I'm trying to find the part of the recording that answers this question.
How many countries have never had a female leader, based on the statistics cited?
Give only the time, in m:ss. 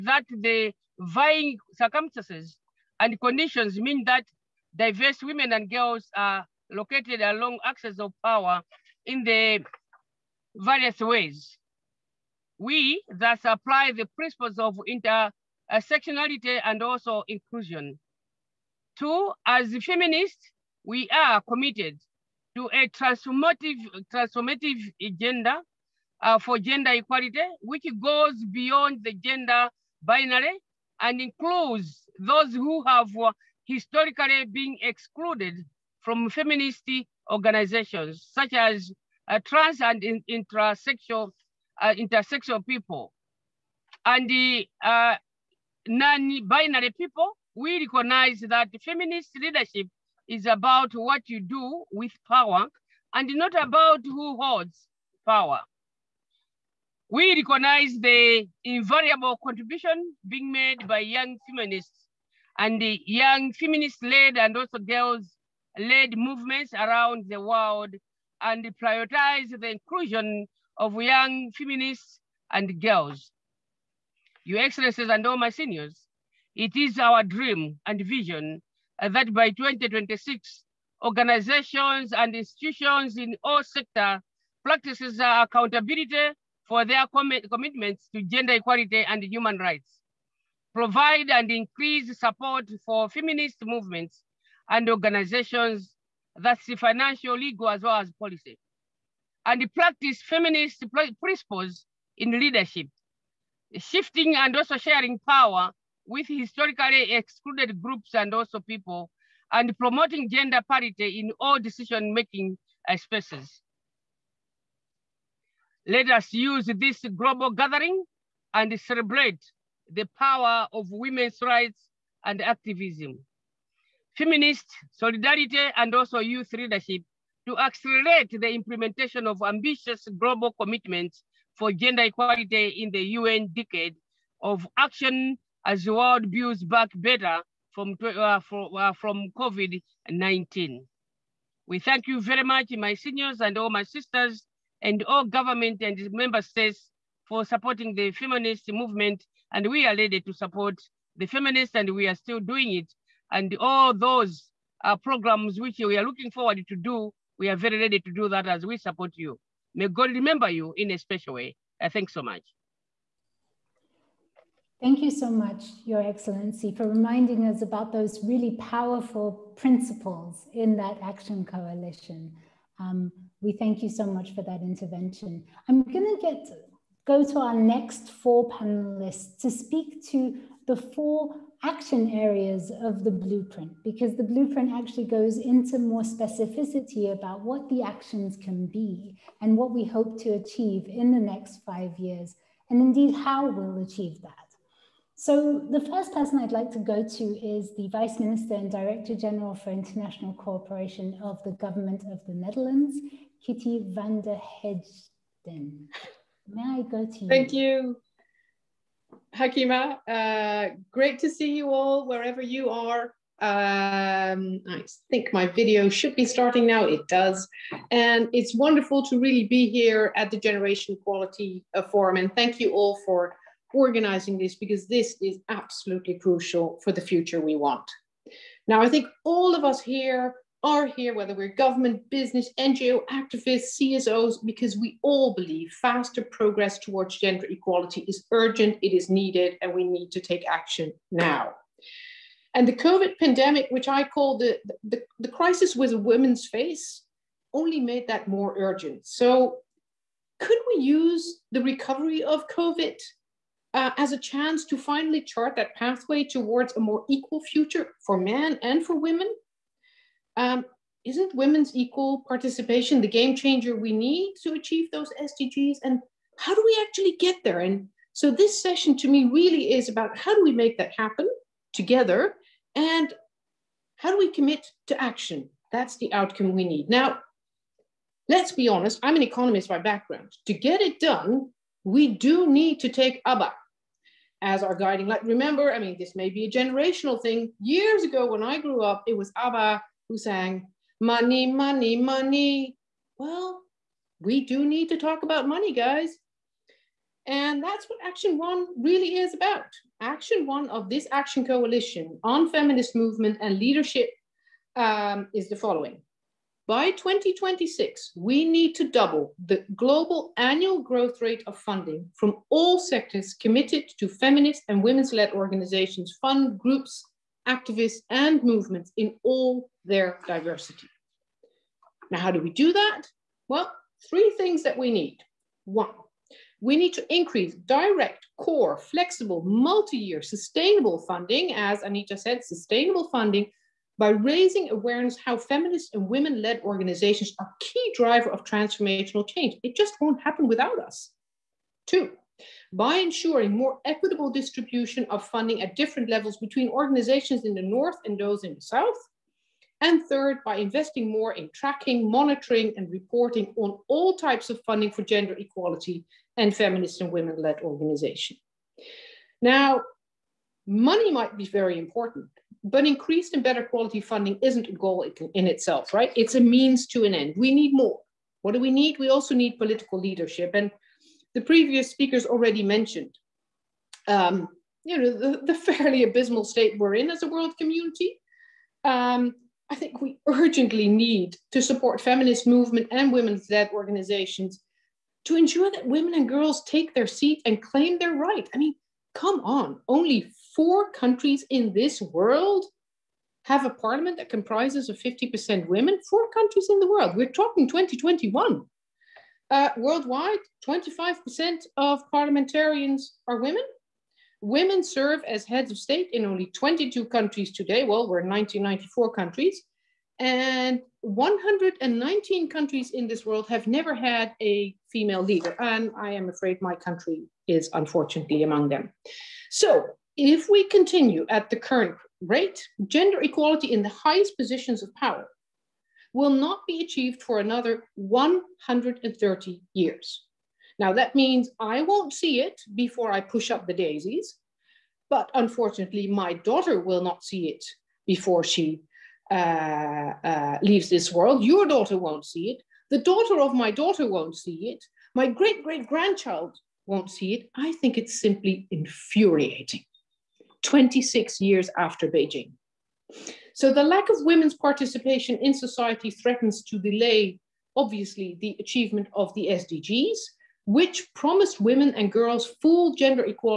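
6:51.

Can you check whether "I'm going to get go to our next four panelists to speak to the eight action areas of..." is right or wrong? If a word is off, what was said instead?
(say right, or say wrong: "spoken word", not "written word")
wrong: "four", not "eight".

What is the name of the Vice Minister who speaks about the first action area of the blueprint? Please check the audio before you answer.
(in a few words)
Kitty van der Heijden.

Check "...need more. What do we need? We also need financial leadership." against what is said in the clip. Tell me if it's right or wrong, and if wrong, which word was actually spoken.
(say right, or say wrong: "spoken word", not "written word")
wrong: "political", not "financial".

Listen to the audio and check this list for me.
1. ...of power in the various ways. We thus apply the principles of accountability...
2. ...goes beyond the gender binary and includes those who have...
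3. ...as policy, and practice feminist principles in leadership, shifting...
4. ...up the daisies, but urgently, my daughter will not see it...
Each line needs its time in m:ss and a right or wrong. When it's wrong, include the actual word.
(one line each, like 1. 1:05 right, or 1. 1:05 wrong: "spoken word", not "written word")
1. 0:07 wrong: "intersectionality", not "accountability"
2. 0:28 right
3. 1:38 right
4. 7:13 wrong: "unfortunately", not "urgently".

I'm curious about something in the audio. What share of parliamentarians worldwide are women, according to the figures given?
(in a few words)
25%.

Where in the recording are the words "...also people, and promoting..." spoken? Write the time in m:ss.
1:48.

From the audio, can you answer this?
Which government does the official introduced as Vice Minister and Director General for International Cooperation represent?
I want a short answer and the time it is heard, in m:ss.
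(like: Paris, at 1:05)
Netherlands, at 3:22.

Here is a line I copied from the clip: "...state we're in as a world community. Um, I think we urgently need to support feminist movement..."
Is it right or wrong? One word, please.
right.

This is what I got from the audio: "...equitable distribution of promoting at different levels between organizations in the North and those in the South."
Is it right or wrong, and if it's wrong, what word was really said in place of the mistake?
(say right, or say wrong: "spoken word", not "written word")
wrong: "funding", not "promoting".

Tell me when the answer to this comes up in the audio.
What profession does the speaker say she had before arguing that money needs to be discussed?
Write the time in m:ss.
4:39.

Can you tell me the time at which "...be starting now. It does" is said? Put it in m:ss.
3:36.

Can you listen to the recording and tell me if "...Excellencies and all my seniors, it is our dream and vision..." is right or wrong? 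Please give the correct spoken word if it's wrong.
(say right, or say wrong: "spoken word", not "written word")
right.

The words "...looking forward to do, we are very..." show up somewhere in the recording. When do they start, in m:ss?
2:36.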